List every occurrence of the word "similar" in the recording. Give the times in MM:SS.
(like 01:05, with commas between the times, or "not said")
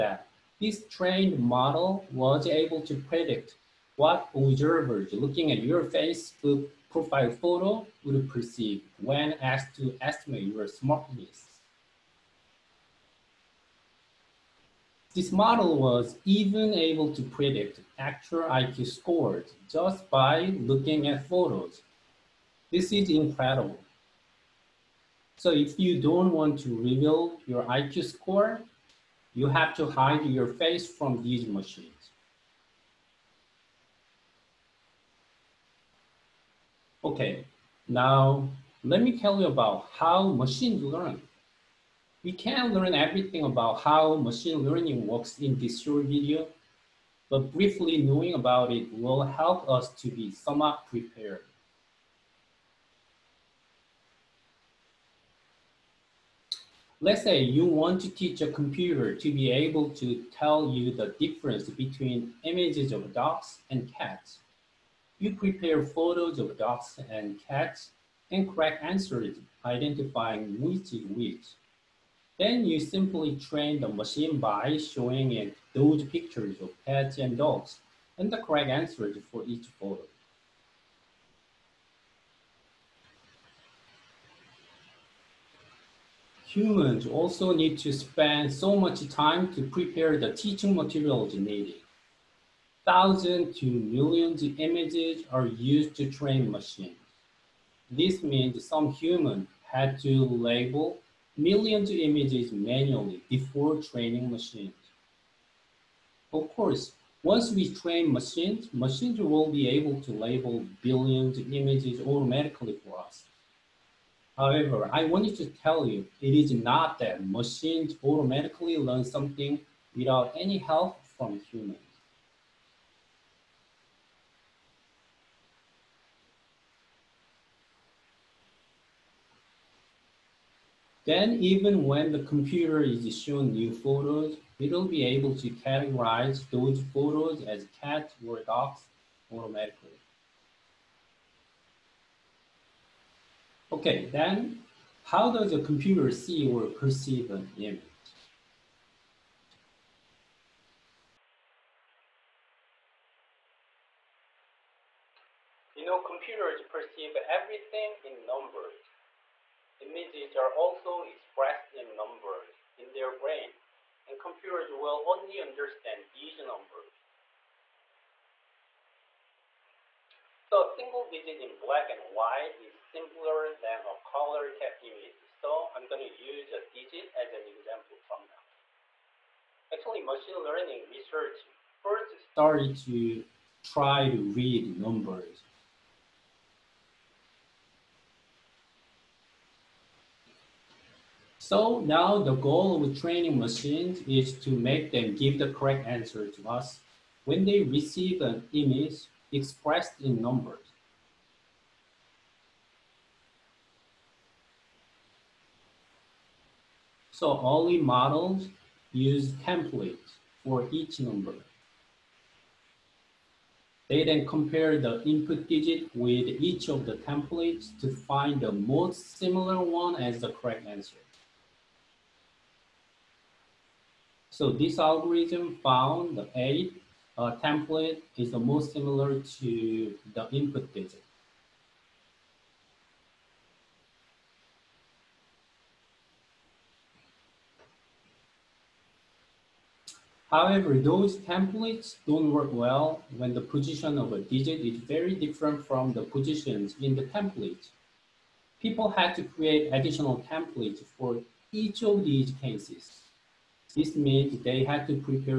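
03:39, 03:48.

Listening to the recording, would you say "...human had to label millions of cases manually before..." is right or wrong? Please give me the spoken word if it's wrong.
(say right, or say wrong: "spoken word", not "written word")
wrong: "images", not "cases".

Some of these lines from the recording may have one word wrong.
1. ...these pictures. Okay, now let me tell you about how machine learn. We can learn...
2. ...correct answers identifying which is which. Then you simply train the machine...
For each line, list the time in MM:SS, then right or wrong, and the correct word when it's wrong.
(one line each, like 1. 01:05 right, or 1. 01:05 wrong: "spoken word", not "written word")
1. 00:31 wrong: "machines", not "pictures"
2. 01:08 right.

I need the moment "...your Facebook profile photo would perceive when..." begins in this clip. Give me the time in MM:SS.
00:05.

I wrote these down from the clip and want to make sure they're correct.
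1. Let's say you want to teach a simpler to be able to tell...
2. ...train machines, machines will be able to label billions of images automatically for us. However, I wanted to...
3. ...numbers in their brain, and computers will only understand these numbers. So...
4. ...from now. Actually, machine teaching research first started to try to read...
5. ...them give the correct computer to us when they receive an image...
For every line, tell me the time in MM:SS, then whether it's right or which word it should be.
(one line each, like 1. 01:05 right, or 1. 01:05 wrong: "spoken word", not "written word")
1. 00:57 wrong: "computer", not "simpler"
2. 01:47 right
3. 02:41 right
4. 02:58 wrong: "learning", not "teaching"
5. 03:14 wrong: "answer", not "computer".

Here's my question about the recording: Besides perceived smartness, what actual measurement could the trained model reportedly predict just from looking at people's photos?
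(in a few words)
IQ scores.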